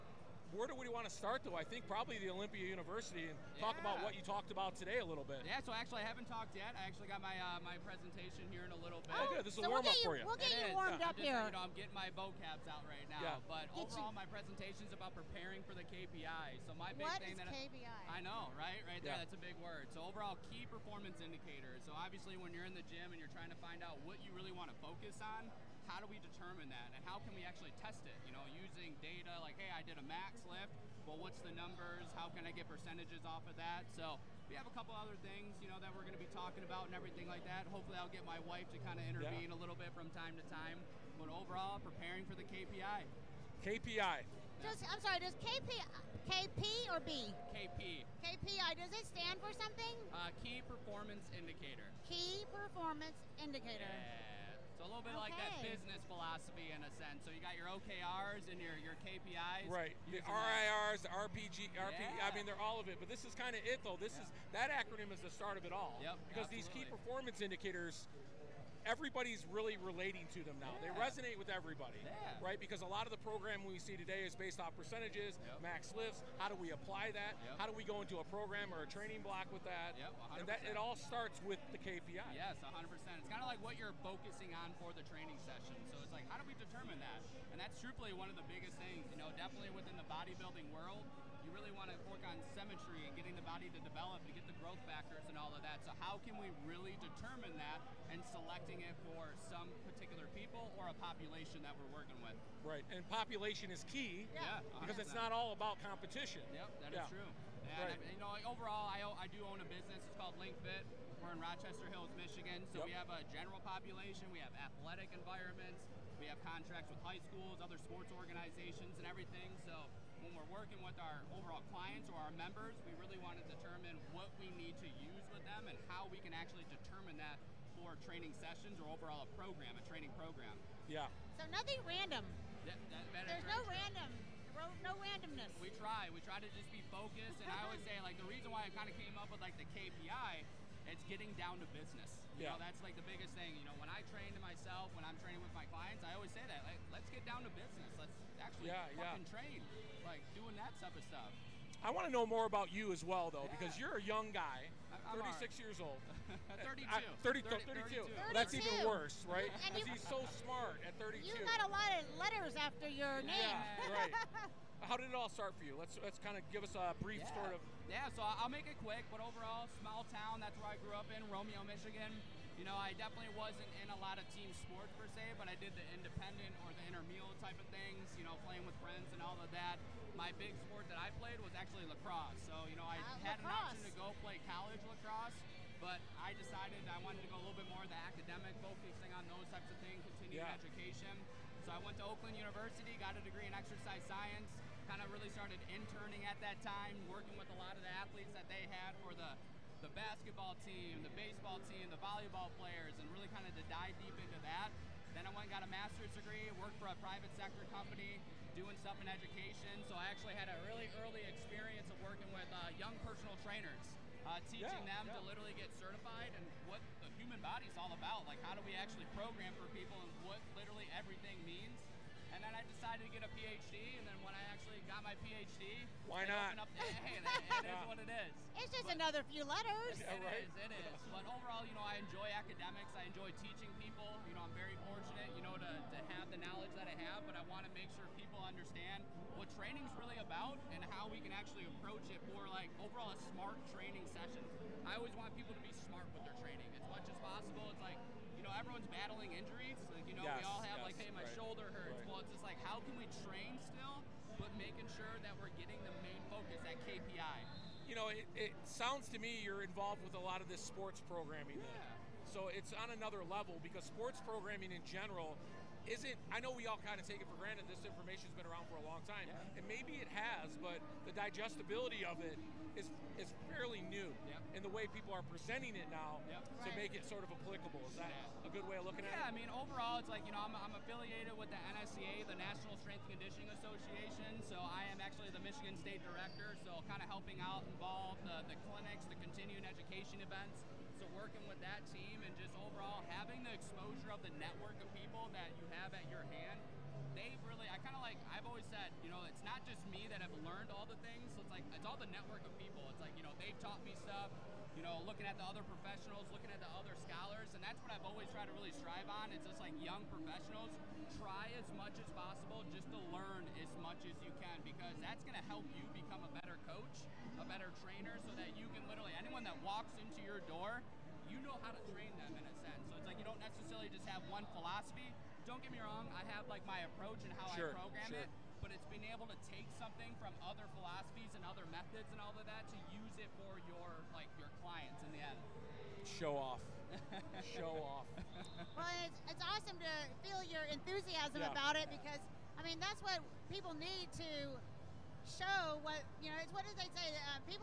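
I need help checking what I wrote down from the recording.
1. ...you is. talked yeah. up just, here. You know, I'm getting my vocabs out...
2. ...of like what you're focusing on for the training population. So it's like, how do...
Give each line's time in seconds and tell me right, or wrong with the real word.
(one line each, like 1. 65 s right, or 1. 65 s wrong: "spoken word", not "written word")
1. 10 s wrong: "warmed", not "talked"
2. 83 s wrong: "session", not "population".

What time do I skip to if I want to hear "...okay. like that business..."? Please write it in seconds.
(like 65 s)
55 s.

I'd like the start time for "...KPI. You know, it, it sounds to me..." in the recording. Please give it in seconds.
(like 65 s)
256 s.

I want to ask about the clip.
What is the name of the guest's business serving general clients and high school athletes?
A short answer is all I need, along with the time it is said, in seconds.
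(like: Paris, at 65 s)
LinkFit, at 110 s.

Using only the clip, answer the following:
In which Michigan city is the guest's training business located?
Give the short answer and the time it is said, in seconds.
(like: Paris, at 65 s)
Rochester Hills, at 111 s.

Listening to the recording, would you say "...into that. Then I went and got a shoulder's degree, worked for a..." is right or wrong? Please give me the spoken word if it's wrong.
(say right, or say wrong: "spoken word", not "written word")
wrong: "master", not "shoulder".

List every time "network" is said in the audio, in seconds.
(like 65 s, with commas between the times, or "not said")
294 s, 302 s.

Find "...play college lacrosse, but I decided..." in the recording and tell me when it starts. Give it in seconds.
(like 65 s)
184 s.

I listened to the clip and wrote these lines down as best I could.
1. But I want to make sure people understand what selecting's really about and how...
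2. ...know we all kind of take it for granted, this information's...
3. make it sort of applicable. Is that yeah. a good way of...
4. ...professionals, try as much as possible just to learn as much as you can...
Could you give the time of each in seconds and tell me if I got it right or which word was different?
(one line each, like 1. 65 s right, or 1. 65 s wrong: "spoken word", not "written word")
1. 237 s wrong: "training", not "selecting"
2. 266 s right
3. 276 s right
4. 310 s right.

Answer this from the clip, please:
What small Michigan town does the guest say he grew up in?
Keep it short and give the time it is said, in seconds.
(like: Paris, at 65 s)
Romeo, at 171 s.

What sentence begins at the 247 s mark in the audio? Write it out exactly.
It's like know, everyone's battling injuries.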